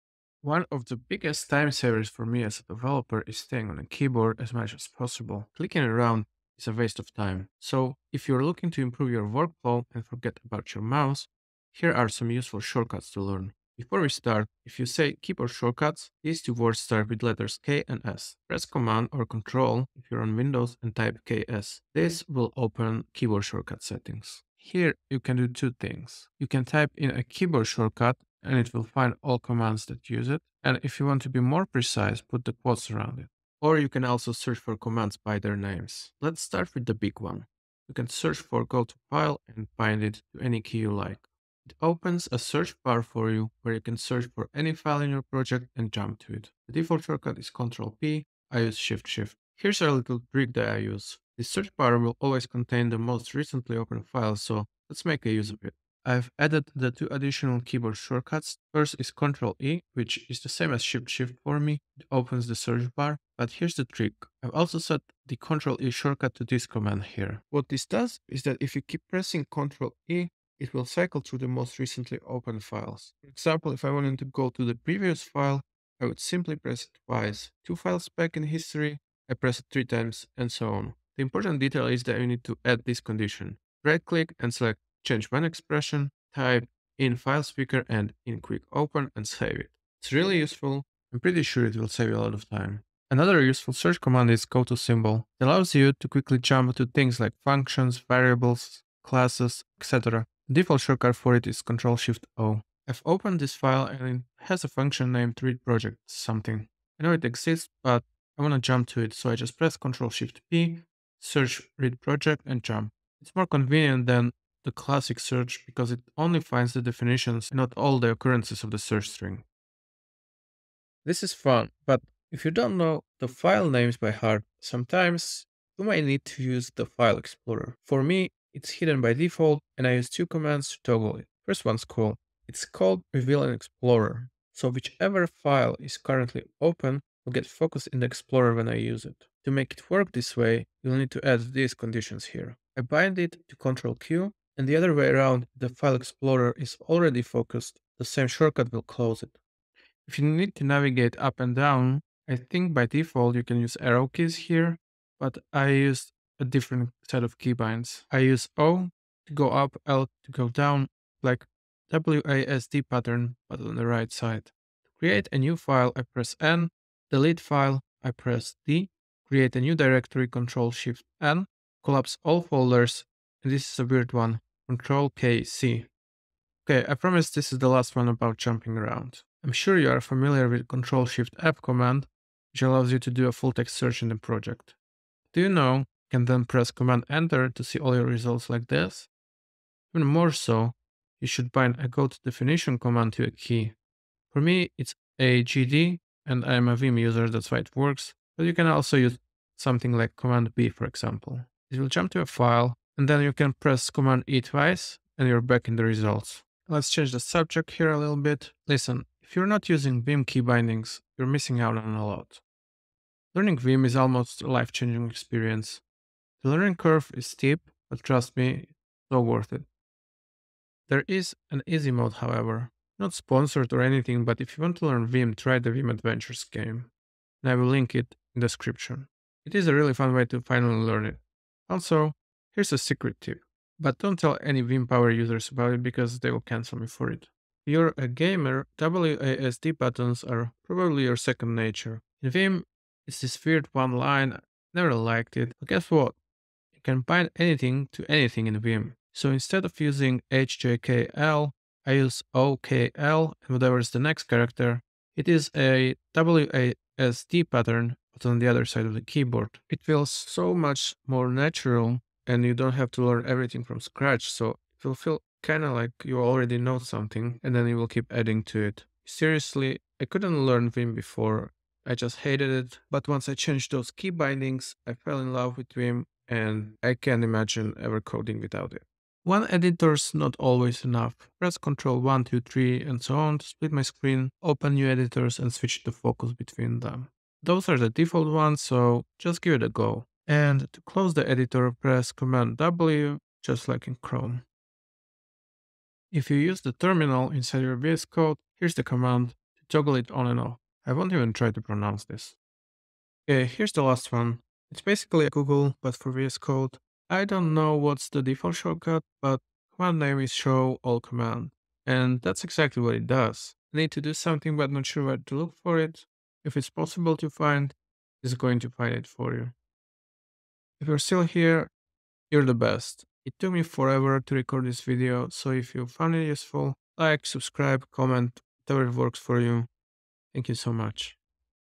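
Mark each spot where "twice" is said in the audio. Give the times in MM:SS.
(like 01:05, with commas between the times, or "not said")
01:17, 03:24.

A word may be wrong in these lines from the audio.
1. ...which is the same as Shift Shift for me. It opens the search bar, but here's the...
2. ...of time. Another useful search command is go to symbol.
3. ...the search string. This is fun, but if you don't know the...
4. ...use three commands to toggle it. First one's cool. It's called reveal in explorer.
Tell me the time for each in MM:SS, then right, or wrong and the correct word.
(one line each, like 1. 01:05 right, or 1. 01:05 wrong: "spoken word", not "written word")
1. 00:59 right
2. 01:32 right
3. 01:58 right
4. 02:09 wrong: "two", not "three".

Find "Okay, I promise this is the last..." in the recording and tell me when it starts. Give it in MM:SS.
02:56.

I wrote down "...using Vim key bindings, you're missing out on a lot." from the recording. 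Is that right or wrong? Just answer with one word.
right.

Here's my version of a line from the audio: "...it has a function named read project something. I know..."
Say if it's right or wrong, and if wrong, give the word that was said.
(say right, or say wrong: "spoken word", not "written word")
right.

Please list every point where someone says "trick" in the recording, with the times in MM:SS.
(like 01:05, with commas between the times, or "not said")
00:50, 01:03.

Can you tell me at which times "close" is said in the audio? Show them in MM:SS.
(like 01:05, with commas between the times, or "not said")
02:28, 04:50.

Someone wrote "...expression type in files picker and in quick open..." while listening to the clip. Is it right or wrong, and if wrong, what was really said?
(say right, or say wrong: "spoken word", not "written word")
right.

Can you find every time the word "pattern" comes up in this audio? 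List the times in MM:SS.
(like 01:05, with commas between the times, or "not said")
02:42, 04:17.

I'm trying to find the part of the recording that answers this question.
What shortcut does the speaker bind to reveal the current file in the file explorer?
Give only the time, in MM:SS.
02:23.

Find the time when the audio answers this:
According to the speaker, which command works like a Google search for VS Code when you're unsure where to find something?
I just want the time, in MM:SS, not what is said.
05:10.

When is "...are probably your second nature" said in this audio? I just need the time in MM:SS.
04:00.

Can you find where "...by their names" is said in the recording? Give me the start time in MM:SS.
00:35.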